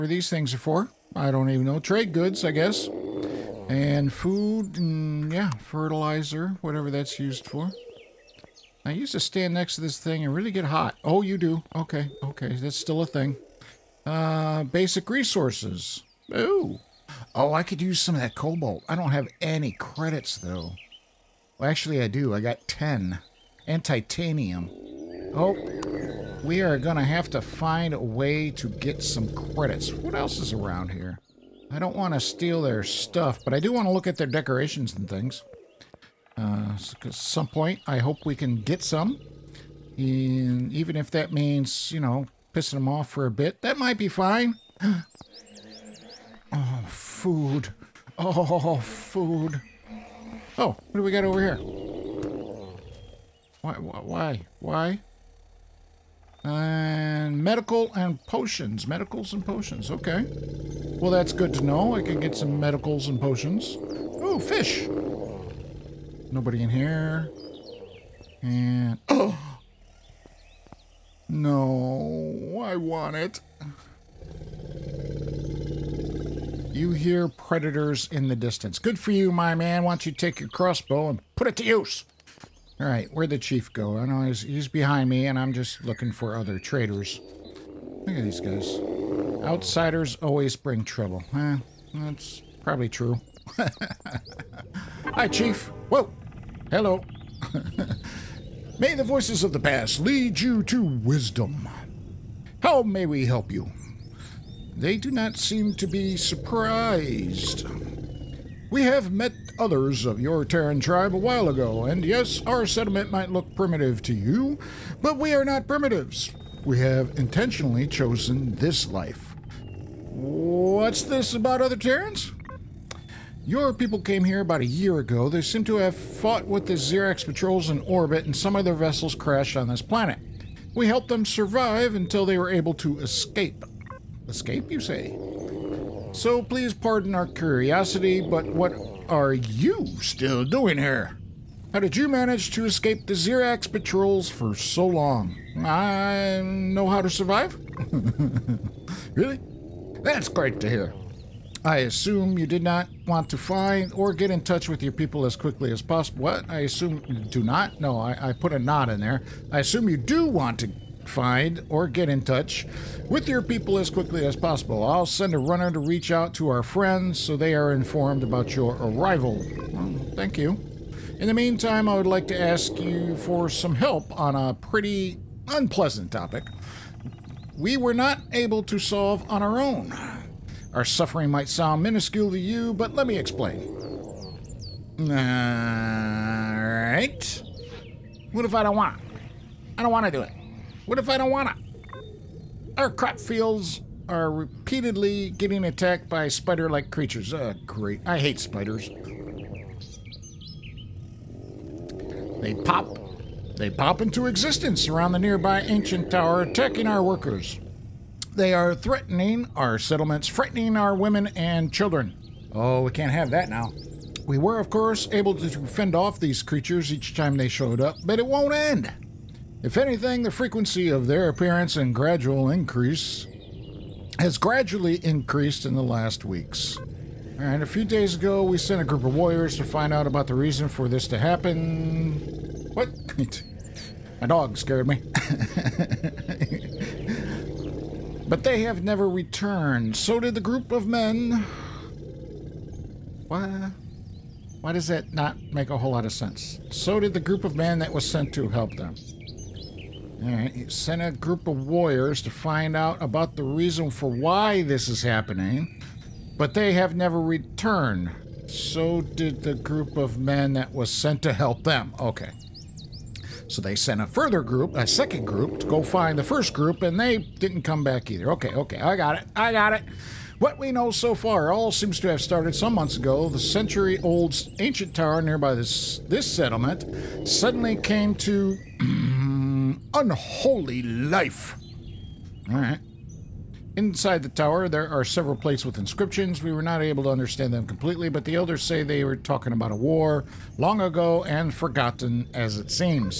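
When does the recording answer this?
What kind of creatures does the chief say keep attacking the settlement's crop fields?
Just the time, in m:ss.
3:16.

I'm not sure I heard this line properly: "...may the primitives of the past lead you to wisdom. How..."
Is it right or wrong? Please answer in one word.
wrong.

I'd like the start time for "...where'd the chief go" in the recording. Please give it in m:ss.
1:23.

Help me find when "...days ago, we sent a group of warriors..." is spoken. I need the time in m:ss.
3:47.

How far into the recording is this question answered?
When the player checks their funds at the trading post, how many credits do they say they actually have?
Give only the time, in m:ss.
0:22.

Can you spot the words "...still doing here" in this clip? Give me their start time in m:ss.
2:20.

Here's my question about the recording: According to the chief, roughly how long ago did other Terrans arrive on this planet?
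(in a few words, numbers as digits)
About a year ago.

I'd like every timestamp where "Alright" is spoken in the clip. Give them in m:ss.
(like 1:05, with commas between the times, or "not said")
3:04.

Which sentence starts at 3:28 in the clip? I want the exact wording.
They are threatening our settlements, frightening our women and children.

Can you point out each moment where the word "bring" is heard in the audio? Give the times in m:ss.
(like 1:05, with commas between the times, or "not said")
1:30.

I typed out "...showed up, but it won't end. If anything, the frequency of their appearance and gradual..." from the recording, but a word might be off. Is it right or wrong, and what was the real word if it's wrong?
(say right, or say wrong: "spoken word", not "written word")
right.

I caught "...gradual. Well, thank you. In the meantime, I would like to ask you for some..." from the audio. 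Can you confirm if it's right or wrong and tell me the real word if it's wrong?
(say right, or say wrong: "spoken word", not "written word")
wrong: "arrival", not "gradual".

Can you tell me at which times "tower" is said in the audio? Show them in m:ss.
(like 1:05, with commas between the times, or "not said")
3:26, 4:34, 4:44.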